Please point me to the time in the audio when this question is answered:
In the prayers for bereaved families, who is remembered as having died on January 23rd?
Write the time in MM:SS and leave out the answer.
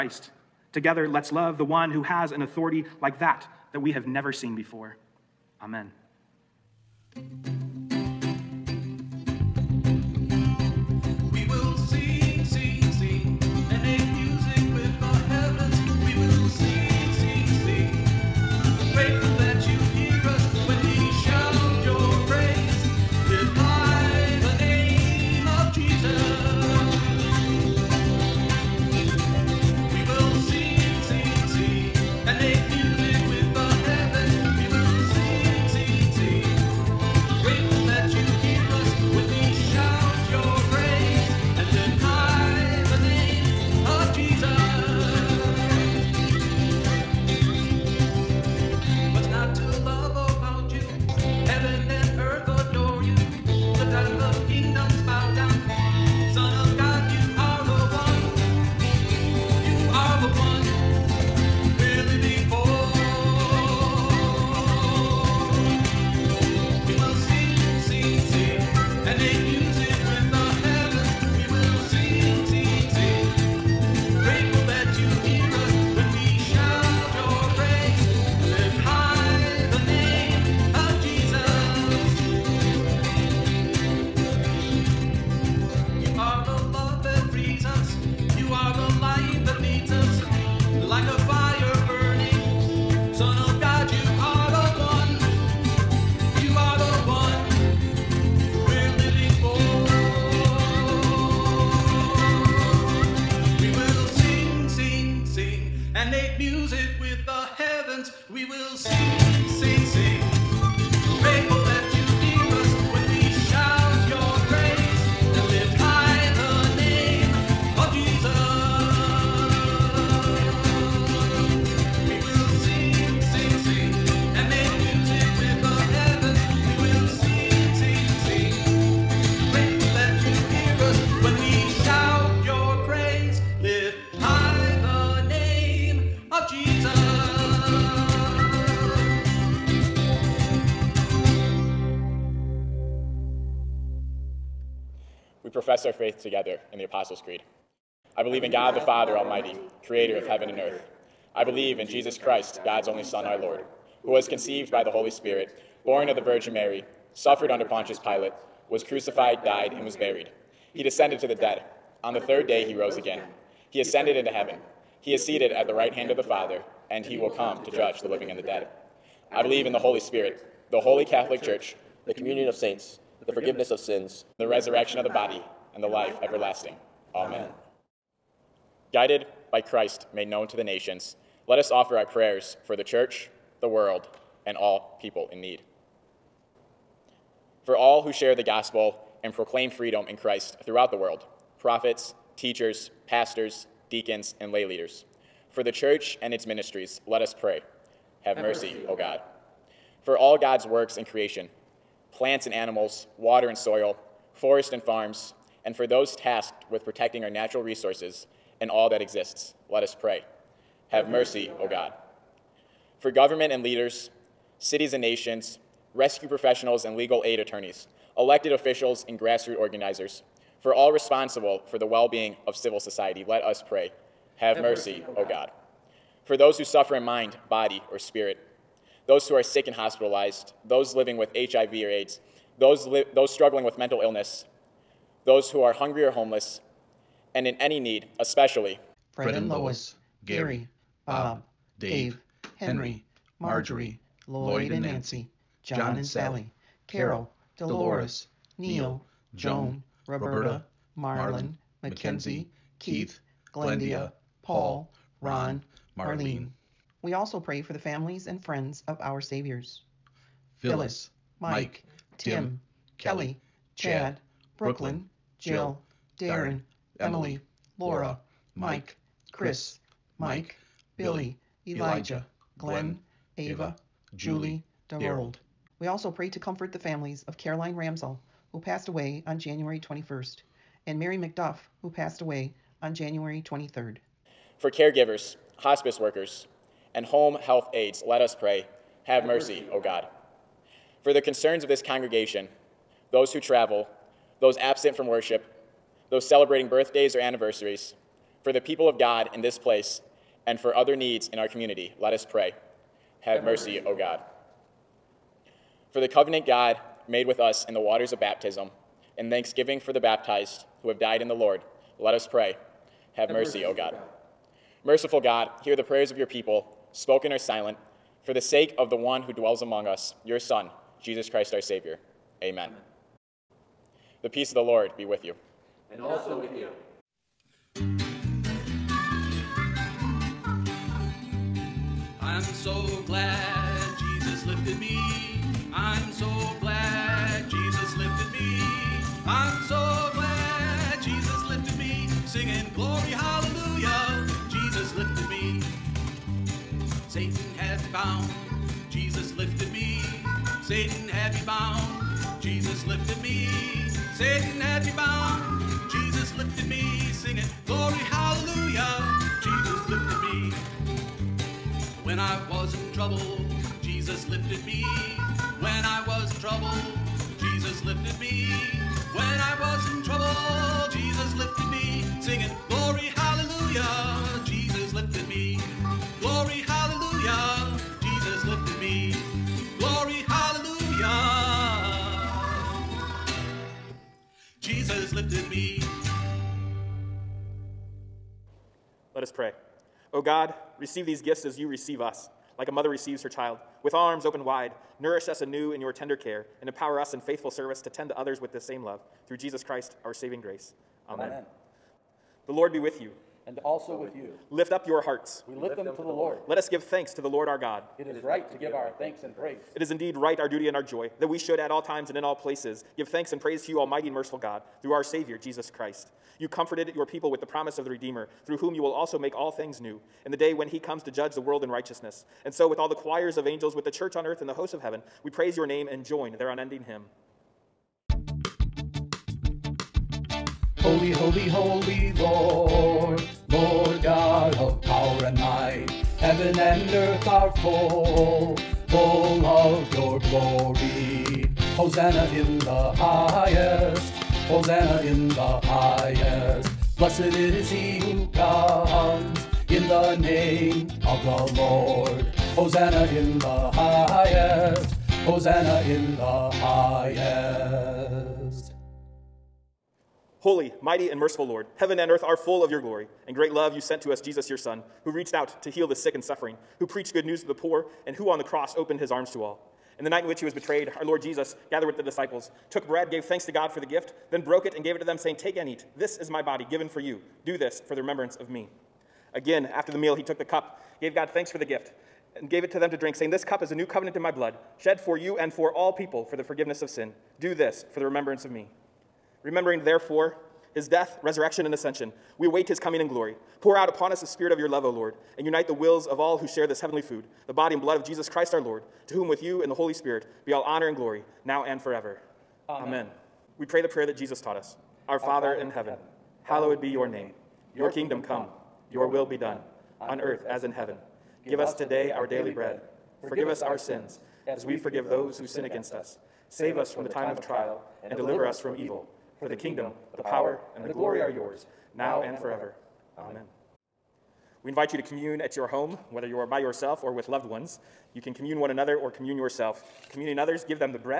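04:40.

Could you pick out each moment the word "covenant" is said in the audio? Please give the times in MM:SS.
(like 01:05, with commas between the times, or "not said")
05:06, 08:03.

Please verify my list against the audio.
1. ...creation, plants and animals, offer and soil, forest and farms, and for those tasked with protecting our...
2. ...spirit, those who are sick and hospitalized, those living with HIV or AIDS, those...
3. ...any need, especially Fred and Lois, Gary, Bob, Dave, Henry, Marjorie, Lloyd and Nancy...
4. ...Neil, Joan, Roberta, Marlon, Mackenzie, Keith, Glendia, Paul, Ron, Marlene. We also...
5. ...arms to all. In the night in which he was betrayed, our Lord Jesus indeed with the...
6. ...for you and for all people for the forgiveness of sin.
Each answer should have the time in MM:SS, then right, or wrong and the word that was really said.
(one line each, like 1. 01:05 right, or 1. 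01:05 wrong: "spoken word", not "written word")
1. 03:21 wrong: "water", not "offer"
2. 03:47 right
3. 03:57 right
4. 04:08 right
5. 07:49 wrong: "gathered", not "indeed"
6. 08:04 right.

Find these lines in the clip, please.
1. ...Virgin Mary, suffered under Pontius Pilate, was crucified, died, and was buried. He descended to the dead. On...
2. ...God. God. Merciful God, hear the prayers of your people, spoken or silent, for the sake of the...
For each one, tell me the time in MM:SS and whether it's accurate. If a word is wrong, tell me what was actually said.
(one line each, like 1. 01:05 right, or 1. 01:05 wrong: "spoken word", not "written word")
1. 02:36 right
2. 05:13 right.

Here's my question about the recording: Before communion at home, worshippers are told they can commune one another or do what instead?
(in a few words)
commune yourself.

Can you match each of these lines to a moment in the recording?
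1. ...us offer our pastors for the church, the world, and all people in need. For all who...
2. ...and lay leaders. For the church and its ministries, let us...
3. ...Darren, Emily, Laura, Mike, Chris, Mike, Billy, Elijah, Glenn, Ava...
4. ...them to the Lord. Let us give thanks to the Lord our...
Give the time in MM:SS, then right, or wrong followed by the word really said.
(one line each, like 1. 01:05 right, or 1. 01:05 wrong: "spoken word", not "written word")
1. 03:01 wrong: "prayers", not "pastors"
2. 03:14 right
3. 04:26 right
4. 06:45 right.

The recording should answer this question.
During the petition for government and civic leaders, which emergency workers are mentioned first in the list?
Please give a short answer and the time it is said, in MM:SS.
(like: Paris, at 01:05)
rescue professionals, at 03:35.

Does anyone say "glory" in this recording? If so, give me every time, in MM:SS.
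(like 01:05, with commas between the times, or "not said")
07:42, 08:13, 08:20, 08:40.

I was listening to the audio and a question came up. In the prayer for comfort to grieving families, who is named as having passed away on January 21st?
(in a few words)
Caroline Ramsell.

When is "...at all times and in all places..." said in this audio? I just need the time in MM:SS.
06:51.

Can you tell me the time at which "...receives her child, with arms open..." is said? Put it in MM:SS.
06:32.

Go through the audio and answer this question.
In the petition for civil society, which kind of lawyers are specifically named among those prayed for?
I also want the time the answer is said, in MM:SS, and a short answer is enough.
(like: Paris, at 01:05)
legal aid attorneys, at 03:36.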